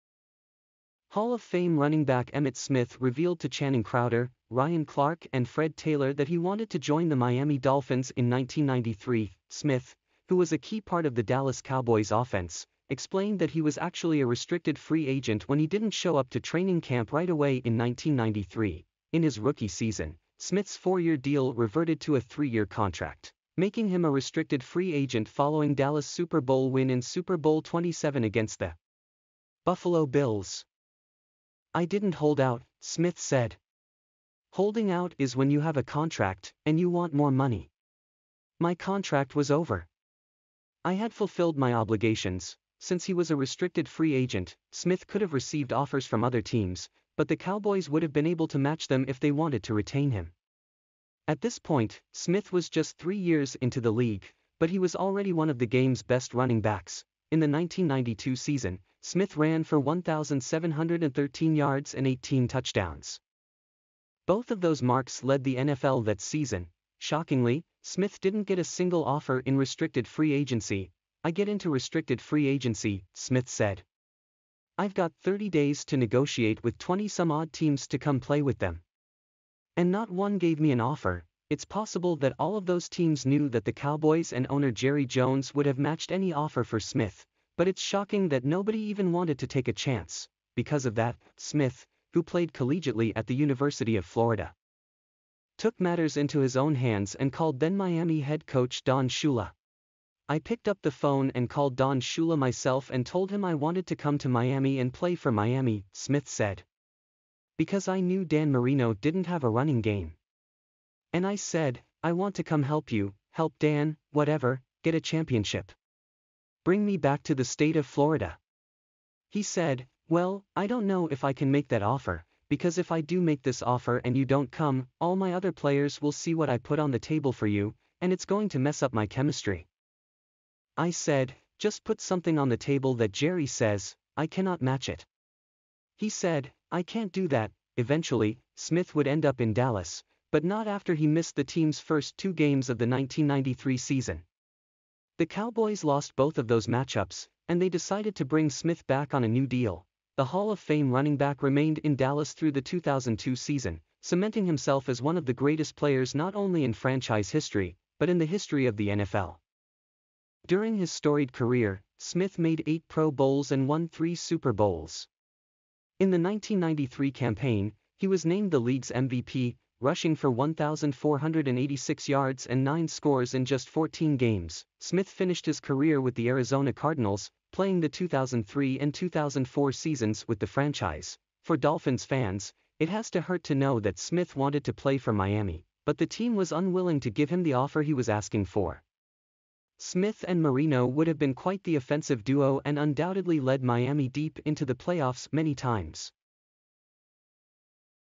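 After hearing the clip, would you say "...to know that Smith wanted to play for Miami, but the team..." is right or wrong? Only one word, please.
right.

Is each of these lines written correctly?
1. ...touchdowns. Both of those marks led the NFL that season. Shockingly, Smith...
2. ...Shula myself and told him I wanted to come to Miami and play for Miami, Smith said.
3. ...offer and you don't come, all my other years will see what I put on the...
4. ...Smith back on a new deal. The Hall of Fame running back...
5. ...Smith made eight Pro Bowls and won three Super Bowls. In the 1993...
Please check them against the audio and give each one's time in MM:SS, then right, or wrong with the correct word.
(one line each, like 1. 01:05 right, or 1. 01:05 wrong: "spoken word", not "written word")
1. 01:02 right
2. 01:41 right
3. 02:03 wrong: "players", not "years"
4. 02:28 right
5. 02:41 right.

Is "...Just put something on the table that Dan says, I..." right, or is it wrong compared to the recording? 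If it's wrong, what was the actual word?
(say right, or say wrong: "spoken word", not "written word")
wrong: "Jerry", not "Dan".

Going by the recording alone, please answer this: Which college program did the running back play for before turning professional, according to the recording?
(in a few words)
University of Florida.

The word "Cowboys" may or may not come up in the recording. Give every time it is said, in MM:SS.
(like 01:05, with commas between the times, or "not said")
00:11, 00:47, 01:23, 02:25.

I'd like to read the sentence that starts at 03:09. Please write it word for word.
Smith and Marino would have been quite the offensive duo and undoubtedly led Miami deep into the playoffs many times.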